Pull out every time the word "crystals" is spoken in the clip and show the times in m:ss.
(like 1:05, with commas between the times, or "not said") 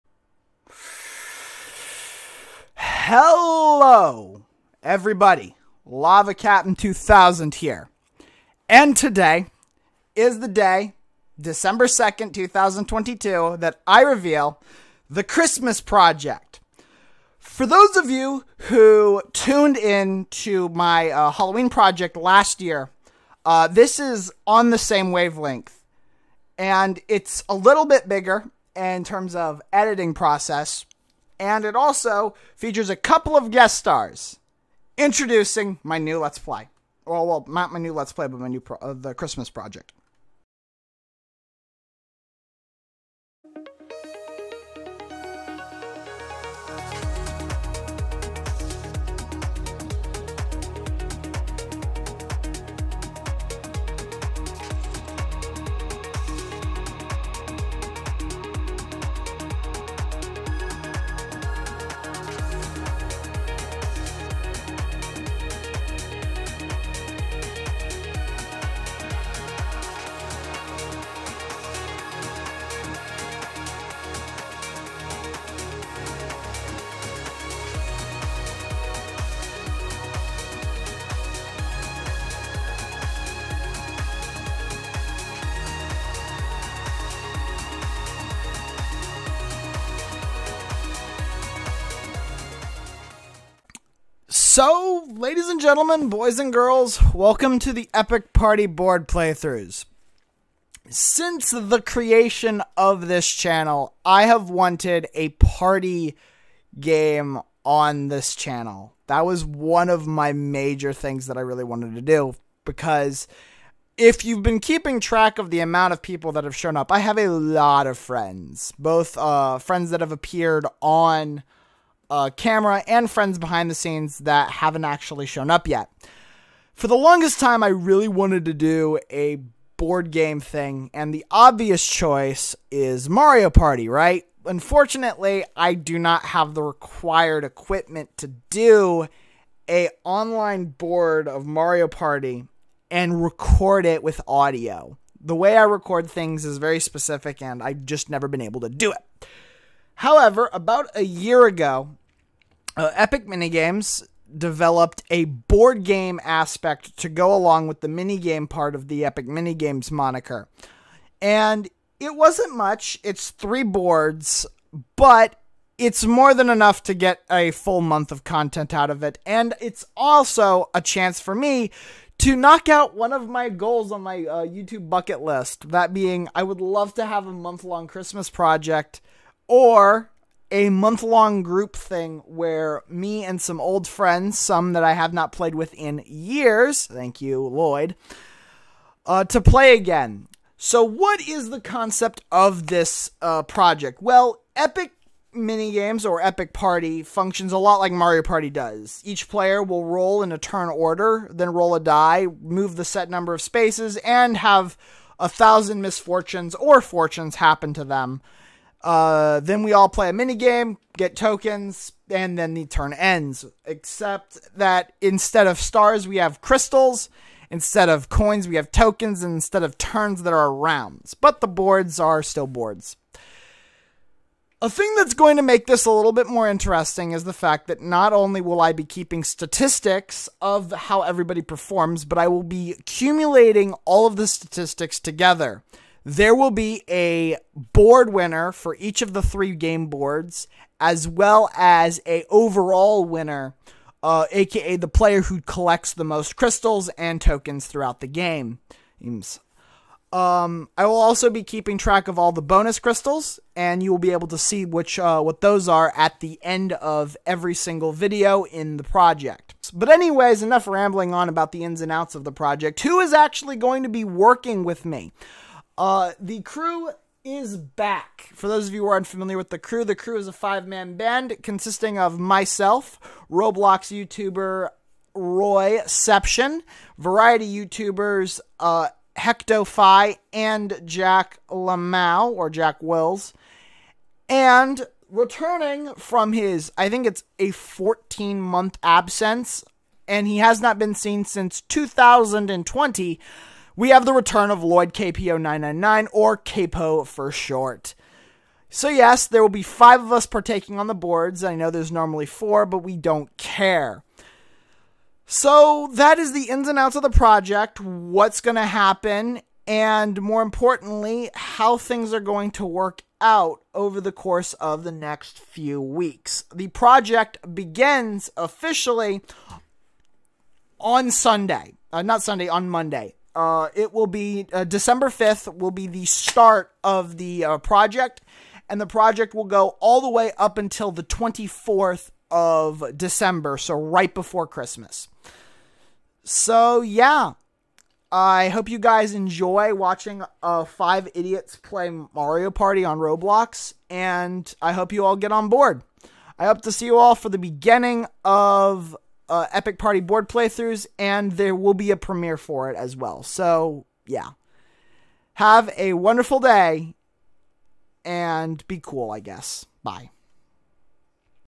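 3:36, 4:06, 4:12.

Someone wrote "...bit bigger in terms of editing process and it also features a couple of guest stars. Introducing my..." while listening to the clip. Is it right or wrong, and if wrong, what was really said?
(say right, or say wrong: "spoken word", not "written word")
right.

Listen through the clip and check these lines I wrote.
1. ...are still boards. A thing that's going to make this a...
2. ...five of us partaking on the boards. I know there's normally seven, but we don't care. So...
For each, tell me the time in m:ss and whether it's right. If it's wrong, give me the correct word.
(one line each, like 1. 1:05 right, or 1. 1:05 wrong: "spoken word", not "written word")
1. 3:41 right
2. 4:59 wrong: "four", not "seven".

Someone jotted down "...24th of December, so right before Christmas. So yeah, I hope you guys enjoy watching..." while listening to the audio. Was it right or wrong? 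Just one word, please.
right.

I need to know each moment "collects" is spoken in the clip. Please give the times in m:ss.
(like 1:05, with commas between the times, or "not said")
4:05.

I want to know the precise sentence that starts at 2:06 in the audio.
For the longest time, I really wanted to do a board game thing, and the obvious choice is Mario Party, right?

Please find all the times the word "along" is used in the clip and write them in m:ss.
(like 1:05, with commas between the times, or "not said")
2:37.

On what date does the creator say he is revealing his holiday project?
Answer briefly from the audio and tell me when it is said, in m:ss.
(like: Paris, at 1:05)
December 2nd, 2022, at 0:11.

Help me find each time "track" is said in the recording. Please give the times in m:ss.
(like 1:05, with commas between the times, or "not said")
1:54, 4:11.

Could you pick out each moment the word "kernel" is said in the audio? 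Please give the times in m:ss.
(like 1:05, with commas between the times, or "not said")
not said.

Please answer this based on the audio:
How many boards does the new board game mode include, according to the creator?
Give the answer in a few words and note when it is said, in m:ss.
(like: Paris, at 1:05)
3, at 2:43.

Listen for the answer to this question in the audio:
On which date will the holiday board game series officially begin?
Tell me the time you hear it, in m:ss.
5:24.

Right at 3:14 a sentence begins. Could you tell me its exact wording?
Well, Epic minigames or Epic Party functions a lot like Mario Party does.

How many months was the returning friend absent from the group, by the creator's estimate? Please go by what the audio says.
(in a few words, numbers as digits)
14.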